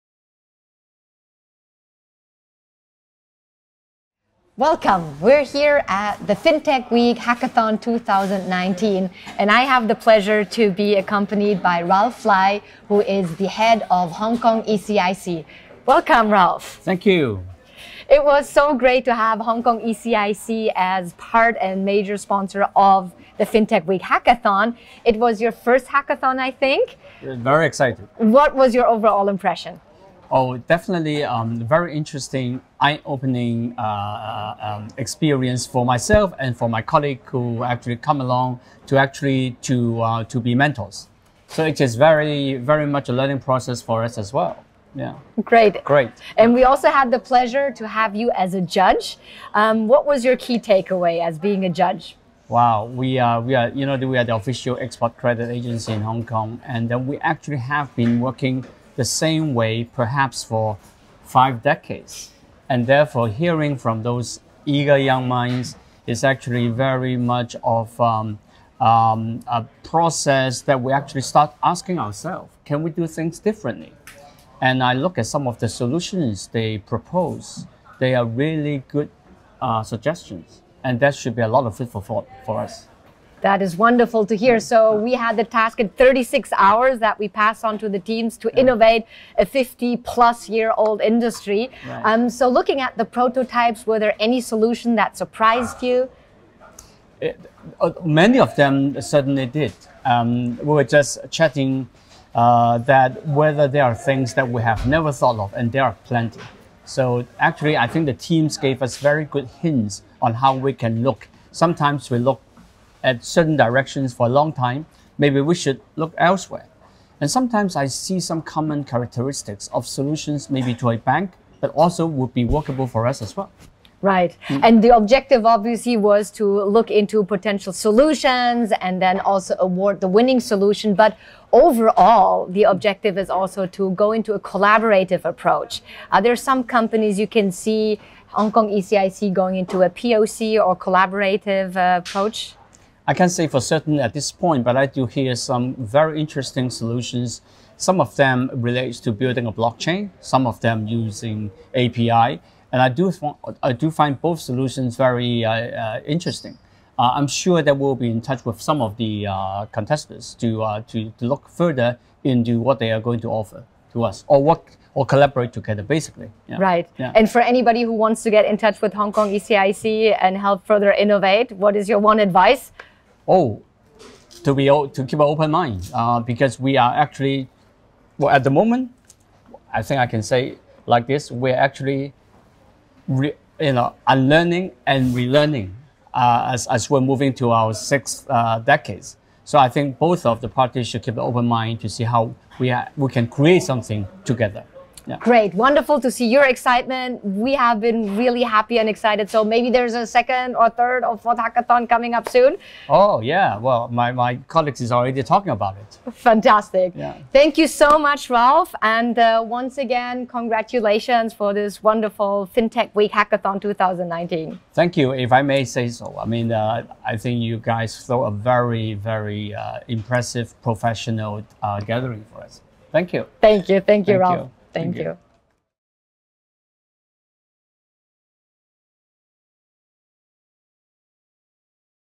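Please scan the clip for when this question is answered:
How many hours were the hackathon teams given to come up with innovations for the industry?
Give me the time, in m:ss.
1:25.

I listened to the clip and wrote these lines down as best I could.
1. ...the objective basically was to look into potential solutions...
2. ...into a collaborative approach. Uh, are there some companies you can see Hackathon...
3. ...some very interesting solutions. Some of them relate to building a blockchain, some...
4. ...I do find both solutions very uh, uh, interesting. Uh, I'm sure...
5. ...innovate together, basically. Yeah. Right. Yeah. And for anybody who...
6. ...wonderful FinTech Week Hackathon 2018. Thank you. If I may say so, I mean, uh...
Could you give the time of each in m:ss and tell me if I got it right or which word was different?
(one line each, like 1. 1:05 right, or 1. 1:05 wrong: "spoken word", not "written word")
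1. 2:04 wrong: "obviously", not "basically"
2. 2:14 wrong: "Hong", not "Hackathon"
3. 2:25 right
4. 2:33 right
5. 2:45 wrong: "collaborate", not "innovate"
6. 3:31 wrong: "2019", not "2018".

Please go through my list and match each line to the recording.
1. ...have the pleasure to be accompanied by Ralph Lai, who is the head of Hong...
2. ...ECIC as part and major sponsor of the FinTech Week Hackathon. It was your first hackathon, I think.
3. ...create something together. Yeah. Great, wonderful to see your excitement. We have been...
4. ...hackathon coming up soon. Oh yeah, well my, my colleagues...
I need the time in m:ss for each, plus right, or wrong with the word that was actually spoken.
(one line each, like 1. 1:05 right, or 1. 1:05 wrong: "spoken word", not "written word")
1. 0:09 right
2. 0:19 right
3. 3:13 right
4. 3:21 right.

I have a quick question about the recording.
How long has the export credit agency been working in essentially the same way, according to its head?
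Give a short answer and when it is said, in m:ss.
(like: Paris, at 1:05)
5 decades, at 1:01.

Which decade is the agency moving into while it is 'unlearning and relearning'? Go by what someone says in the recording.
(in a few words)
sixth.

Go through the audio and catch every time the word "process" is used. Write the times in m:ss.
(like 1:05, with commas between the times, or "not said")
0:43, 1:09.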